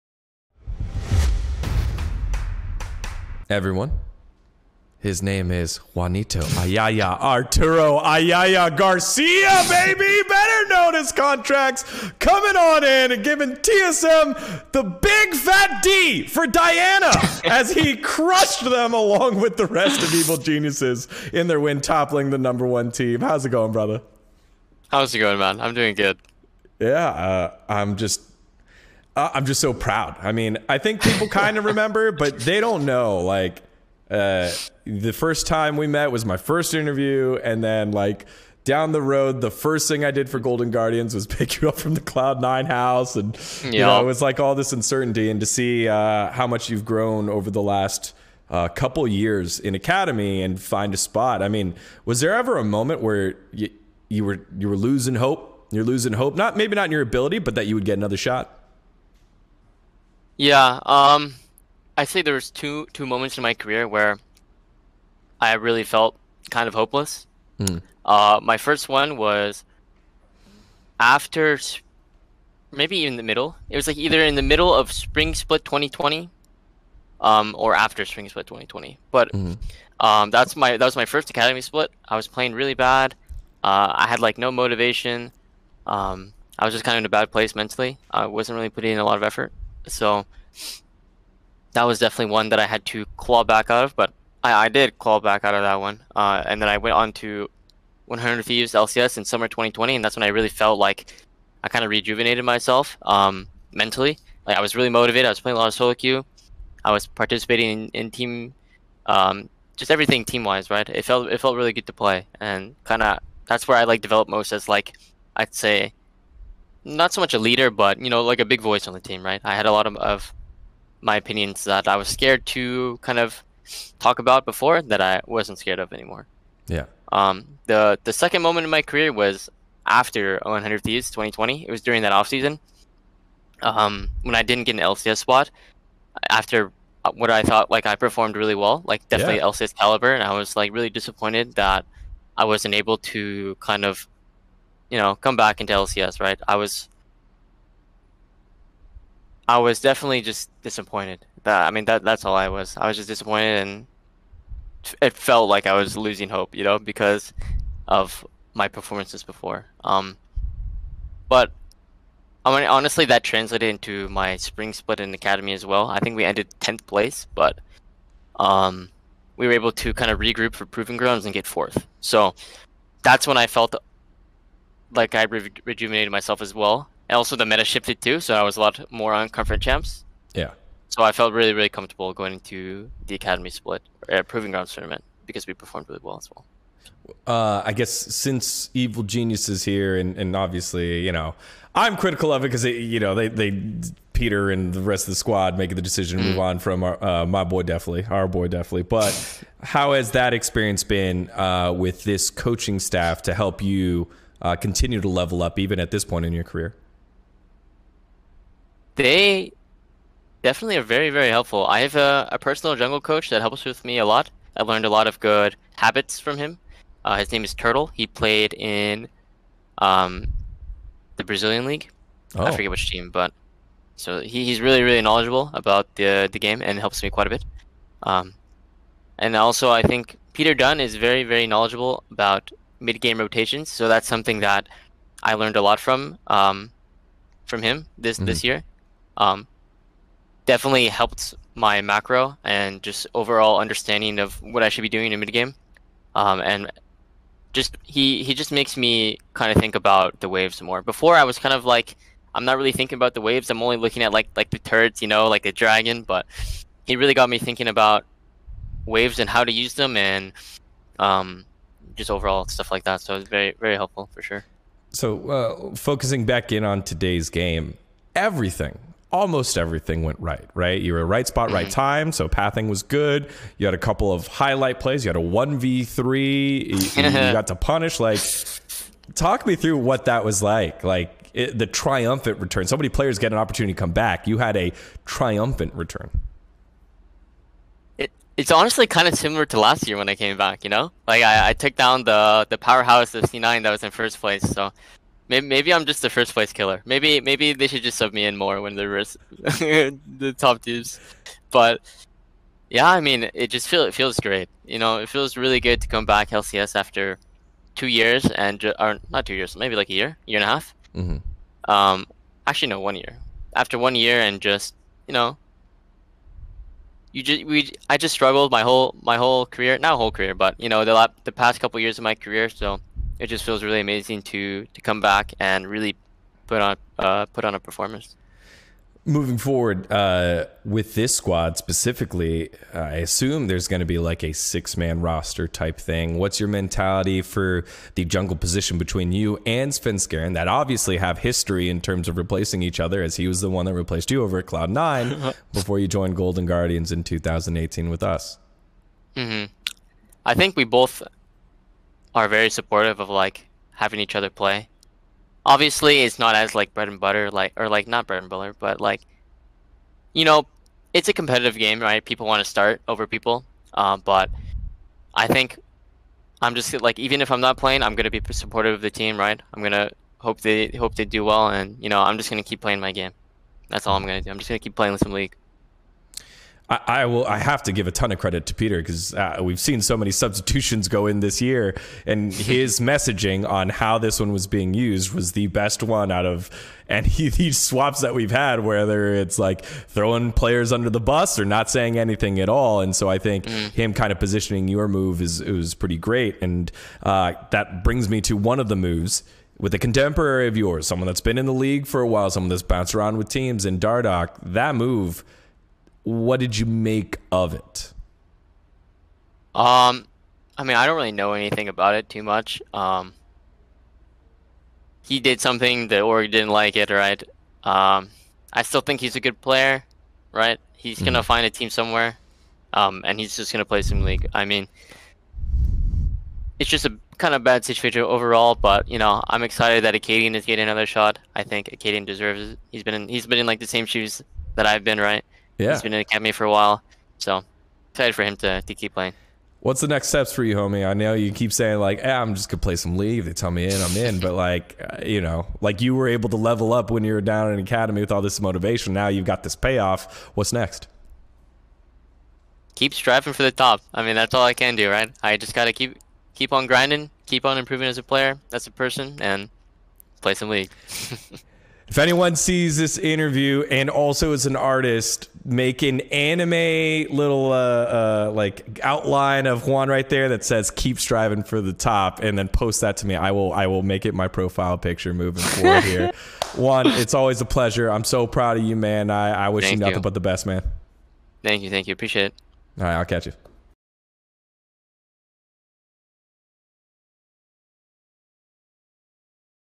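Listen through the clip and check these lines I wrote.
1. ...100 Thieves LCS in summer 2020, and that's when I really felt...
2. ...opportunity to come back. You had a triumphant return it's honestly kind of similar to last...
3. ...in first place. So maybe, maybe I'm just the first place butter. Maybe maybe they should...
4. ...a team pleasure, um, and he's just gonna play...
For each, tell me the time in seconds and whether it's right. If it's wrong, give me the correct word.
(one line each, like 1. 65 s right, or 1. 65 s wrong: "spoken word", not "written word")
1. 98 s right
2. 283 s right
3. 293 s wrong: "killer", not "butter"
4. 421 s wrong: "somewhere", not "pleasure".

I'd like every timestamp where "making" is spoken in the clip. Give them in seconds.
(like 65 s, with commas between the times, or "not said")
195 s, 465 s.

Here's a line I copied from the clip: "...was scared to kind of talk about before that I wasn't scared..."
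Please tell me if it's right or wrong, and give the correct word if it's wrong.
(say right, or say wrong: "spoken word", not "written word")
right.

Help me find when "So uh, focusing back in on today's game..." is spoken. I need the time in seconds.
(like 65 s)
264 s.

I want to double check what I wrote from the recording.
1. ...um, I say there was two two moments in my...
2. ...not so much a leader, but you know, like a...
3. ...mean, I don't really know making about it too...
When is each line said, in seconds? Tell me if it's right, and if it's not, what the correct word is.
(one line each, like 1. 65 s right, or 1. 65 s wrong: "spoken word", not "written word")
1. 60 s right
2. 116 s right
3. 410 s wrong: "anything", not "making".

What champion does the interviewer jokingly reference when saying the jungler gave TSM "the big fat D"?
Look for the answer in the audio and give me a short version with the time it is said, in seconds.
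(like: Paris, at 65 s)
Diana, at 16 s.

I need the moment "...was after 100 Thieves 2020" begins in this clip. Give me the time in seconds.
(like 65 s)
129 s.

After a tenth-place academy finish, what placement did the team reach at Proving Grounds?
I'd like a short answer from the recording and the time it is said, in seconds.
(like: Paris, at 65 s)
fourth, at 171 s.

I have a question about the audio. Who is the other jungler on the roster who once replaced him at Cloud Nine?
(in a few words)
Svenskeren.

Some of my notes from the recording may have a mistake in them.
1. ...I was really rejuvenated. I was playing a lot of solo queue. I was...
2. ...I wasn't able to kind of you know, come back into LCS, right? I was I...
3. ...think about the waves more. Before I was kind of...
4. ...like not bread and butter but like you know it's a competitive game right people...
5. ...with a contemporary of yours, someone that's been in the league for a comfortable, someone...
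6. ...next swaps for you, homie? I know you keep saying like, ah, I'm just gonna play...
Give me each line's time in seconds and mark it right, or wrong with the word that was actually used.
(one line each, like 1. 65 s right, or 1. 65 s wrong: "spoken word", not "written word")
1. 104 s wrong: "motivated", not "rejuvenated"
2. 142 s right
3. 249 s right
4. 357 s right
5. 399 s wrong: "while", not "comfortable"
6. 439 s wrong: "steps", not "swaps".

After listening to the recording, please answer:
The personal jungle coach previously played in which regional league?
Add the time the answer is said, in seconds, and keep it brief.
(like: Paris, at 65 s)
Brazilian League, at 221 s.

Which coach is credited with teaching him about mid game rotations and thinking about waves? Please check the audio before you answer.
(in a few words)
Peter Dun.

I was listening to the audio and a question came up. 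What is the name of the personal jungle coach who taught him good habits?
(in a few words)
Turtle.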